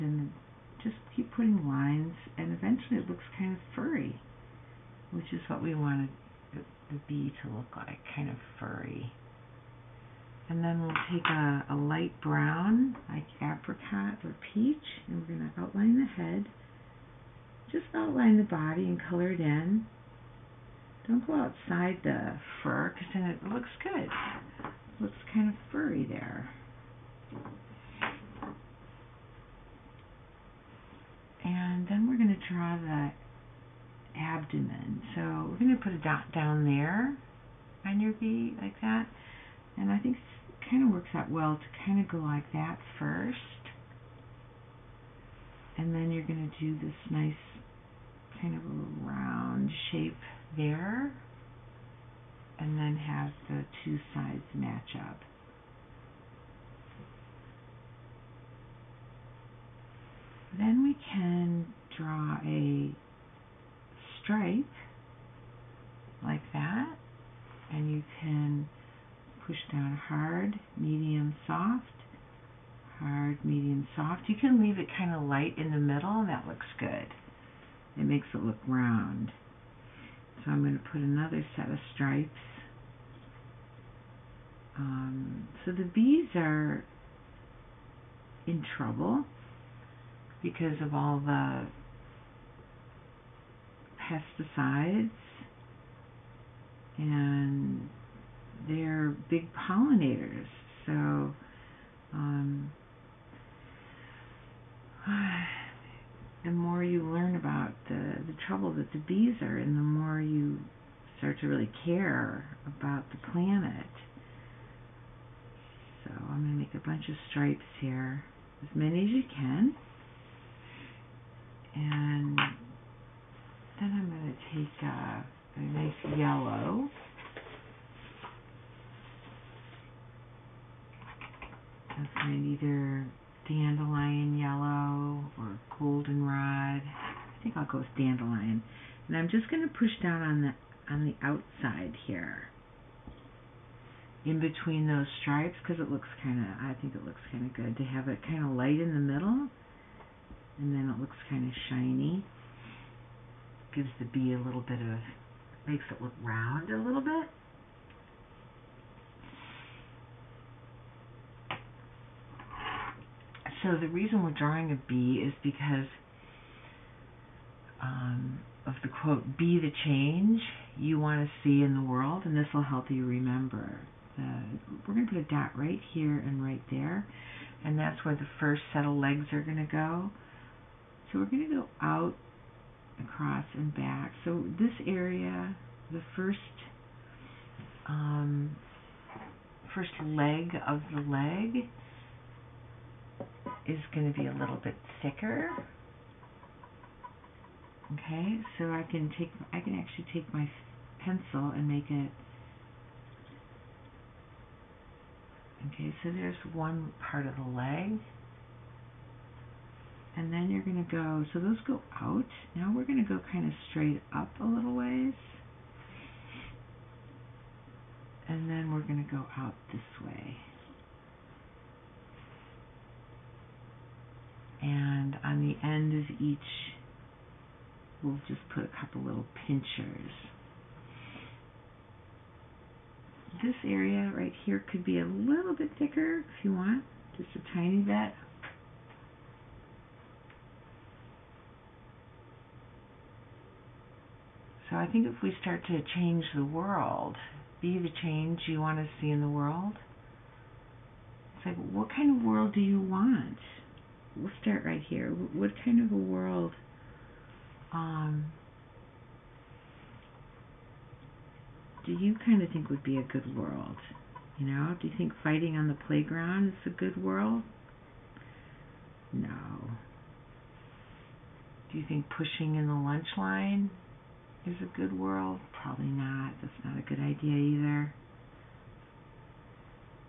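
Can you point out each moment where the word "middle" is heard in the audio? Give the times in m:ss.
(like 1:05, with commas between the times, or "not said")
1:15, 2:28.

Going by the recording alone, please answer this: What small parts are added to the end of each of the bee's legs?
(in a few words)
Pinchers.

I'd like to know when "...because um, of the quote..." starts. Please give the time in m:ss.
2:45.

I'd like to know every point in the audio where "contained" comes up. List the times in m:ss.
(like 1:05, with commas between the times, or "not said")
not said.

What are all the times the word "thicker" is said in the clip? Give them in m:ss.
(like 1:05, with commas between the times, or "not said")
3:15, 3:55.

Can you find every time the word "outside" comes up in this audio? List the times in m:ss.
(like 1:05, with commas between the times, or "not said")
0:21, 2:21.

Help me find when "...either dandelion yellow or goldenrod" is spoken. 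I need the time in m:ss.
2:12.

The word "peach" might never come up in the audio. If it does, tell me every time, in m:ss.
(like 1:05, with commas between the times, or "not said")
0:14.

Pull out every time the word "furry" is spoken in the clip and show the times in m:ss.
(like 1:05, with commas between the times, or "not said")
0:03, 0:08, 0:25.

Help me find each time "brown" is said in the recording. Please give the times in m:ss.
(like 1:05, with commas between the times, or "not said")
0:12.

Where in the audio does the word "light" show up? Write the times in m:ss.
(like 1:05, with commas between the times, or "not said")
0:11, 1:15, 2:28.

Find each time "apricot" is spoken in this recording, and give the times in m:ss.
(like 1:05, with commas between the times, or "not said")
0:13.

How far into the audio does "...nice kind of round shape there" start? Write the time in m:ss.
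0:47.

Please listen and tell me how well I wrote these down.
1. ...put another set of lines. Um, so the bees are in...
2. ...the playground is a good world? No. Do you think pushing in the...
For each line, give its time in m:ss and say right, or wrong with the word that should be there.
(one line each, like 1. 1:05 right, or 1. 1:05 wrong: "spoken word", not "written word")
1. 1:20 wrong: "stripes", not "lines"
2. 4:25 right.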